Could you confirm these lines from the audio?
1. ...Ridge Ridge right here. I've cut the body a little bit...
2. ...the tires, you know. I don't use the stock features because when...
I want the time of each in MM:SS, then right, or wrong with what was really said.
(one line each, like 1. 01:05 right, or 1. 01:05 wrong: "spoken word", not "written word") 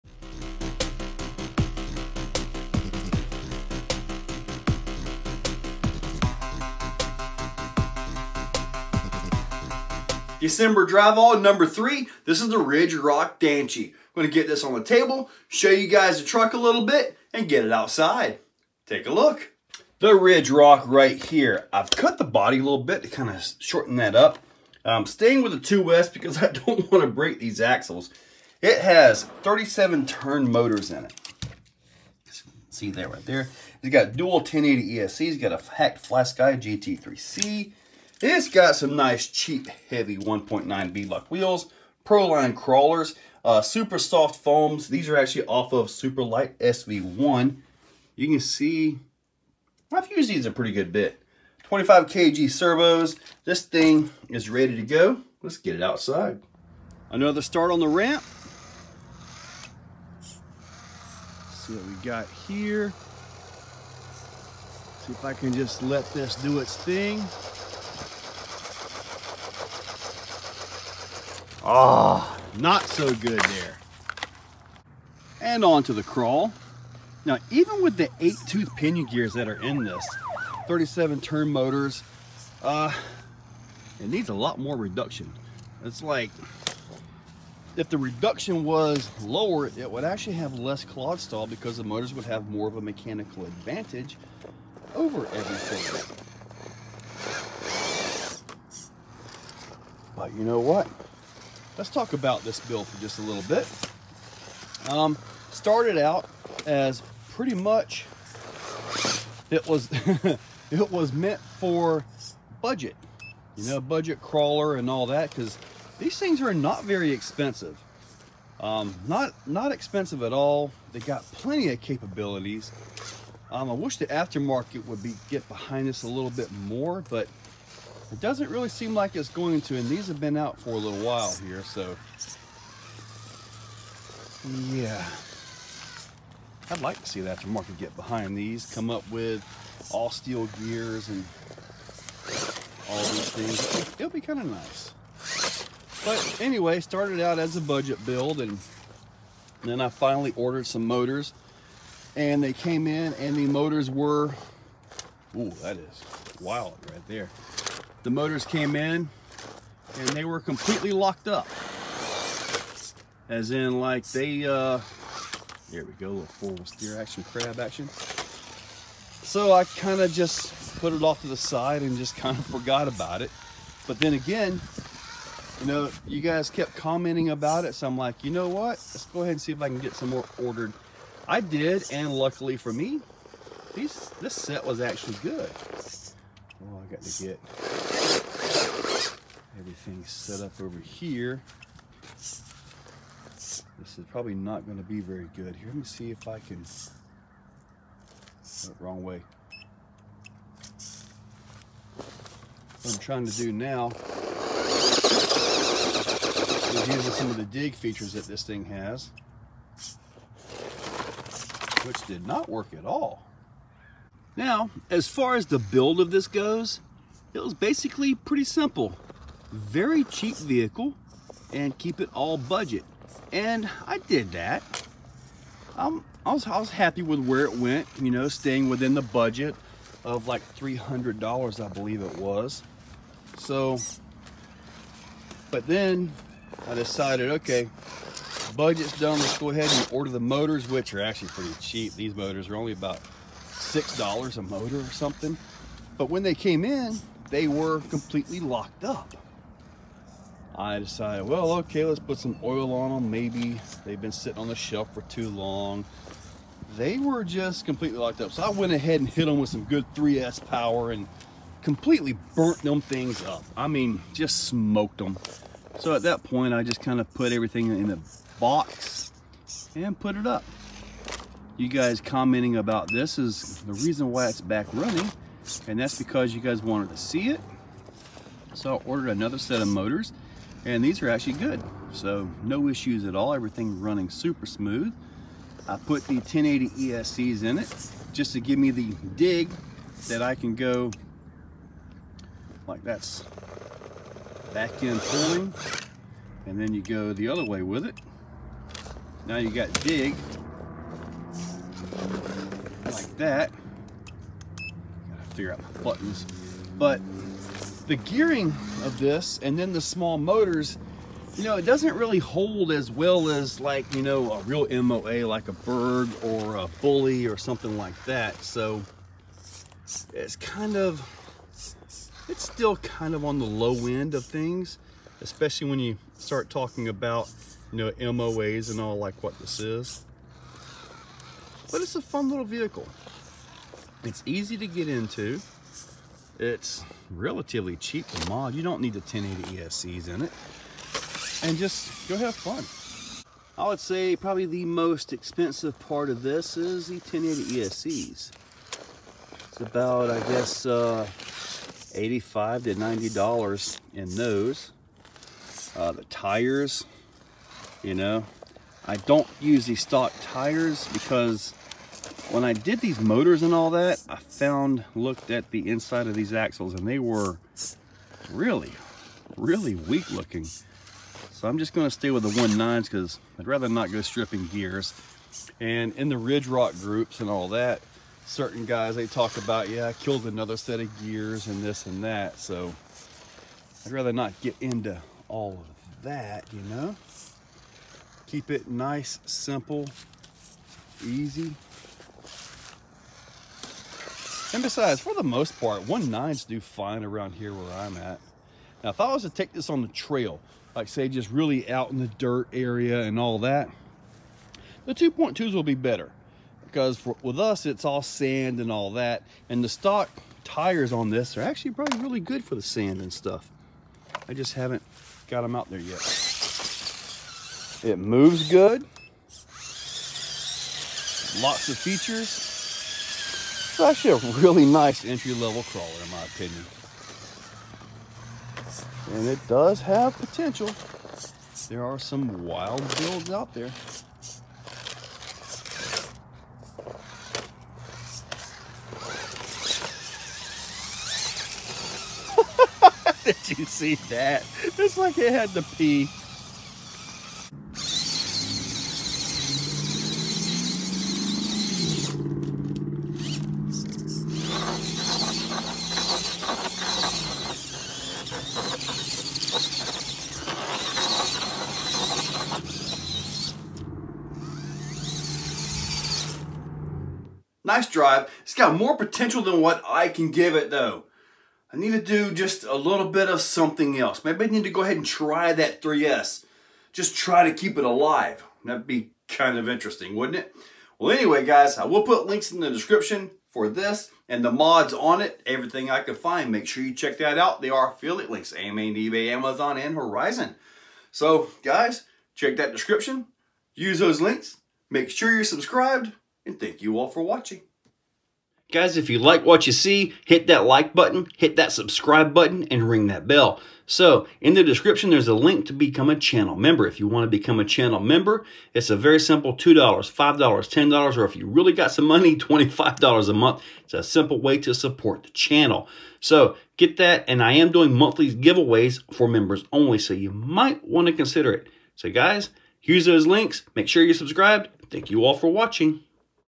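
1. 00:20 wrong: "Rock", not "Ridge"
2. 05:55 wrong: "tires", not "features".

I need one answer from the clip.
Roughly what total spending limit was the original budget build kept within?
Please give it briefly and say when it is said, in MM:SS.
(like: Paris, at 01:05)
$300, at 03:50.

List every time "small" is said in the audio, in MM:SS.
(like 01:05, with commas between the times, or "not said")
05:09.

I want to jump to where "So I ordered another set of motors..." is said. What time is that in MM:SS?
04:38.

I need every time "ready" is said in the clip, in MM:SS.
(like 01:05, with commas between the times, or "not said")
00:54.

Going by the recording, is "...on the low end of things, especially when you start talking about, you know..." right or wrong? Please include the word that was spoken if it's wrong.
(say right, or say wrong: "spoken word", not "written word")
right.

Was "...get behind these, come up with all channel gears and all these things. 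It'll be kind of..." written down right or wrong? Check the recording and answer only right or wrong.
wrong.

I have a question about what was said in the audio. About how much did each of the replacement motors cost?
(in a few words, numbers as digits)
$6.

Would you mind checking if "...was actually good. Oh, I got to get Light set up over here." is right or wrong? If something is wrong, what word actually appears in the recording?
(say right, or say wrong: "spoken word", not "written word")
wrong: "Everything", not "Light".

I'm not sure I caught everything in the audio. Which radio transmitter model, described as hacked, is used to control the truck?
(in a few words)
FlySky GT3C.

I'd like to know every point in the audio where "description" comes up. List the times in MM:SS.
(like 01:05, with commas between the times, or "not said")
08:02, 08:12, 08:24.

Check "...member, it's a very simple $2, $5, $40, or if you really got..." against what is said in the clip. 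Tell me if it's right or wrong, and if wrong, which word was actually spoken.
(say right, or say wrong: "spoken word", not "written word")
wrong: "10", not "40".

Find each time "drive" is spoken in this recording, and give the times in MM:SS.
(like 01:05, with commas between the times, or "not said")
00:10, 07:47.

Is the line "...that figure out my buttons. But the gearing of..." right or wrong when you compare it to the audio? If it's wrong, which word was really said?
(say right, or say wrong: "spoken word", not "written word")
right.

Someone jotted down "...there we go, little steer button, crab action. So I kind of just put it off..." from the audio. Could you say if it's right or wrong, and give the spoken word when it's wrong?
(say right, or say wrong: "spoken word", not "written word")
wrong: "action", not "button".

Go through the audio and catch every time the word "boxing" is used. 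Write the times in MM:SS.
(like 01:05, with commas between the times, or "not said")
not said.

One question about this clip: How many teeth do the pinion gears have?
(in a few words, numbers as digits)
8.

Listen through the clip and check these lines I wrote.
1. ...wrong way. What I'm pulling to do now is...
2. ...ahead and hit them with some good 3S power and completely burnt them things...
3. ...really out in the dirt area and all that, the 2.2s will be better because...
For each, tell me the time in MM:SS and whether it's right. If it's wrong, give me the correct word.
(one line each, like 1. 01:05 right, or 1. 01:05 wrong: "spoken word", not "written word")
1. 03:18 wrong: "trying", not "pulling"
2. 04:18 right
3. 06:41 right.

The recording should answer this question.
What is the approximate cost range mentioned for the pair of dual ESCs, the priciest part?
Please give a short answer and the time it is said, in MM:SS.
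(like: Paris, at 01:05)
$85 to $90, at 05:51.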